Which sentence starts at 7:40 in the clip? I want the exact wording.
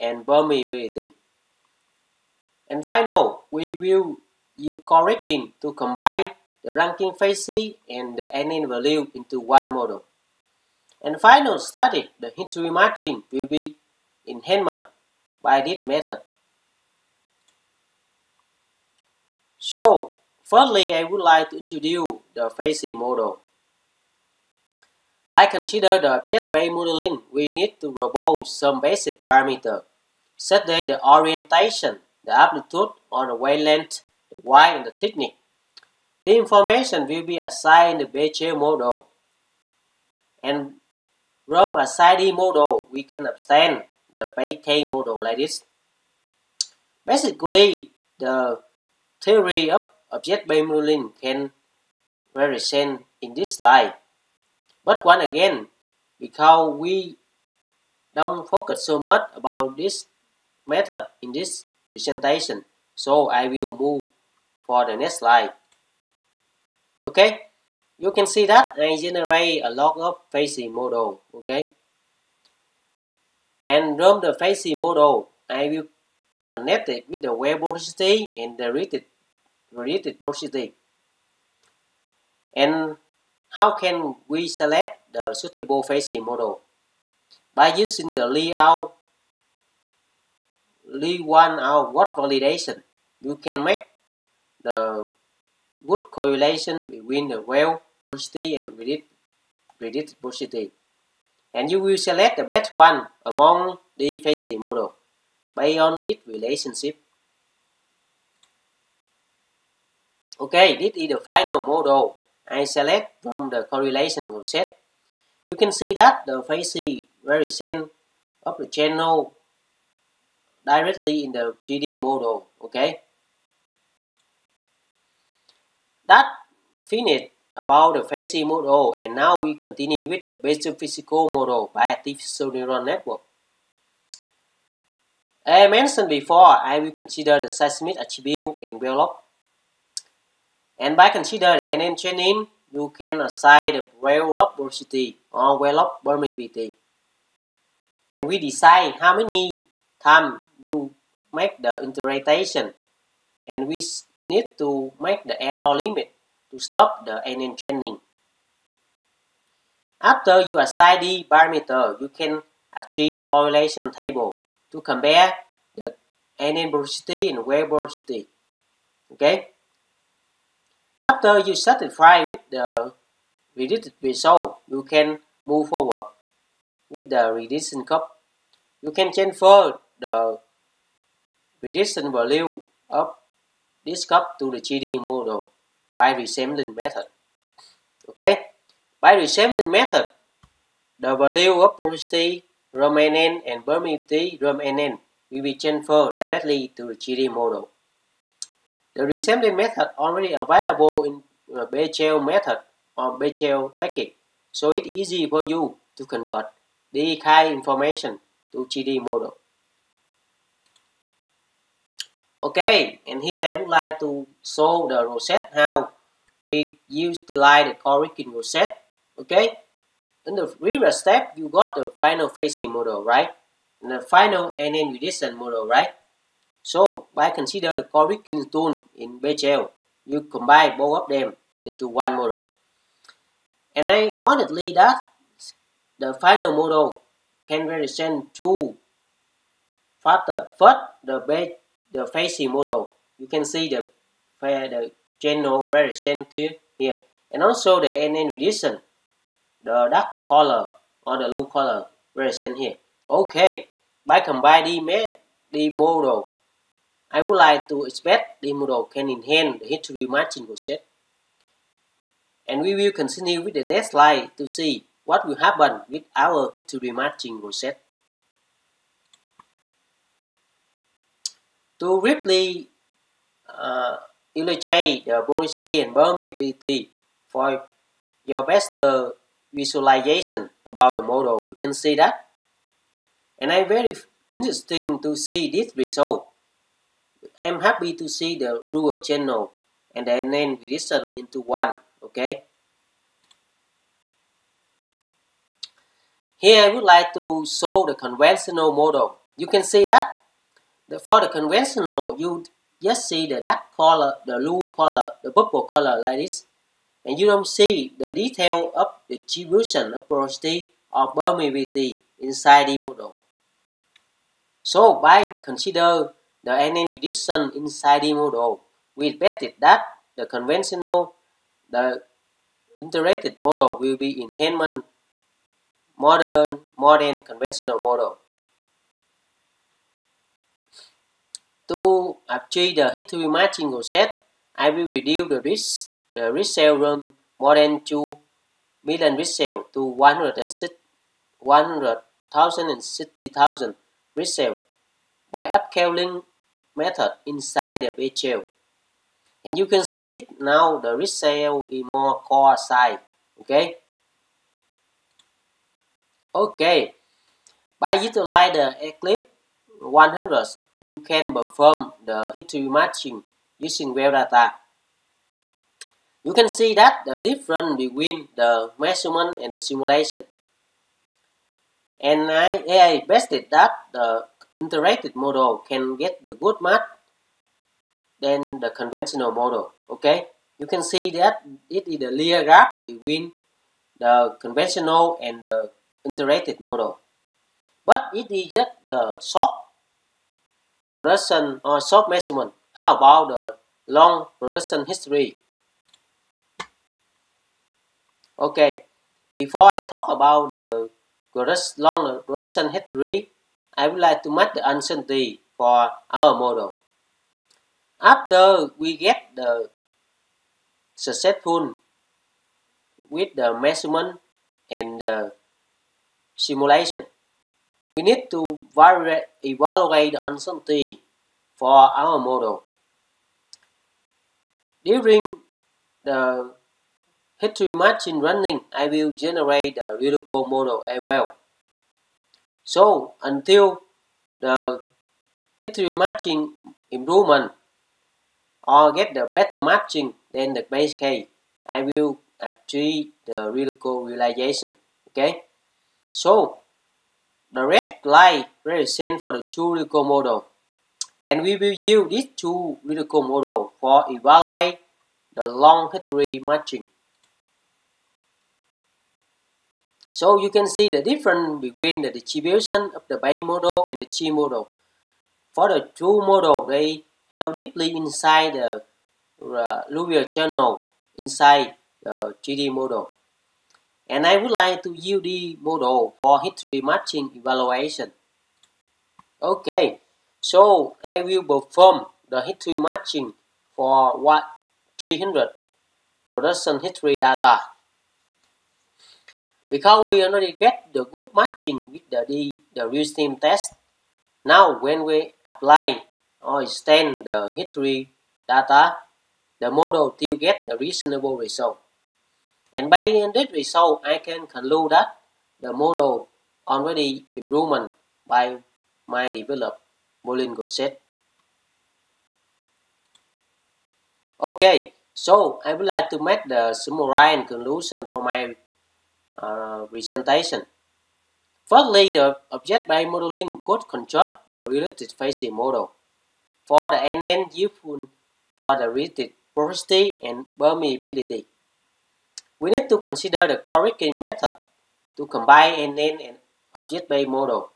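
So you can see the difference between the distribution of the Bay model and the G model.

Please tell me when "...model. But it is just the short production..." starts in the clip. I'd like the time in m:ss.
6:26.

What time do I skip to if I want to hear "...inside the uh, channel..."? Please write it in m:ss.
7:47.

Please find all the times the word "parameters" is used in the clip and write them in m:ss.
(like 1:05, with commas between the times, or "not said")
0:29, 2:41.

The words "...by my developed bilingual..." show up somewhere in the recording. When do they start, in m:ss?
8:28.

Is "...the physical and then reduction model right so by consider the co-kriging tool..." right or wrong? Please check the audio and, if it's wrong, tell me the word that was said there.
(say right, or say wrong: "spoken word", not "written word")
wrong: "final", not "physical".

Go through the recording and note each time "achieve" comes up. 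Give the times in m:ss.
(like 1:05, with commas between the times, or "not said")
2:42, 5:32, 7:22.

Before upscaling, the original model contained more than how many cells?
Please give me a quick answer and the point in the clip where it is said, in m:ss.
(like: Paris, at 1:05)
2 million, at 5:37.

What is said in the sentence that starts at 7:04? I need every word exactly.
During the History match in running, I will generate the Lyrical model as well.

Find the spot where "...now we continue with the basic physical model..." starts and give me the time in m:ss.
2:09.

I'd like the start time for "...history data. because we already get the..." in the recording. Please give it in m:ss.
8:06.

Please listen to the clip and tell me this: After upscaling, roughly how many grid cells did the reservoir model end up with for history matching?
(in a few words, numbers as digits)
160,000.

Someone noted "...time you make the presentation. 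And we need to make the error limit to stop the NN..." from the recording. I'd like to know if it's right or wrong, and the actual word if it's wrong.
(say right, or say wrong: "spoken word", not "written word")
wrong: "interpretation", not "presentation".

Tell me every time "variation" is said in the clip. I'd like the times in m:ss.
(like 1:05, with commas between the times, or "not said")
1:57, 4:05.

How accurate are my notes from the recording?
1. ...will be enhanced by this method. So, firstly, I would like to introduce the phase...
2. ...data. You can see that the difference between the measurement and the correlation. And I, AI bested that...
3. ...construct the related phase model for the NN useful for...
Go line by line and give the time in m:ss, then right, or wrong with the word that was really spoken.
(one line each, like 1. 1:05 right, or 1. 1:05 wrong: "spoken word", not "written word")
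1. 0:13 right
2. 6:04 wrong: "simulation", not "correlation"
3. 8:43 right.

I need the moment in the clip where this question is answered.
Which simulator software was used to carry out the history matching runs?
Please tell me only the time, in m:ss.
5:58.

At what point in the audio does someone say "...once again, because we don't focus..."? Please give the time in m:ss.
0:55.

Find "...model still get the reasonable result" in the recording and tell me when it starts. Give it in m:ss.
8:19.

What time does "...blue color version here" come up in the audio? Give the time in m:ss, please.
4:11.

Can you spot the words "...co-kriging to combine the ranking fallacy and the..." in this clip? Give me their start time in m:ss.
0:04.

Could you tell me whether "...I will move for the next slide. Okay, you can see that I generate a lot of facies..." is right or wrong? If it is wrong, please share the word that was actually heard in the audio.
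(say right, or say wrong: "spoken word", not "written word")
right.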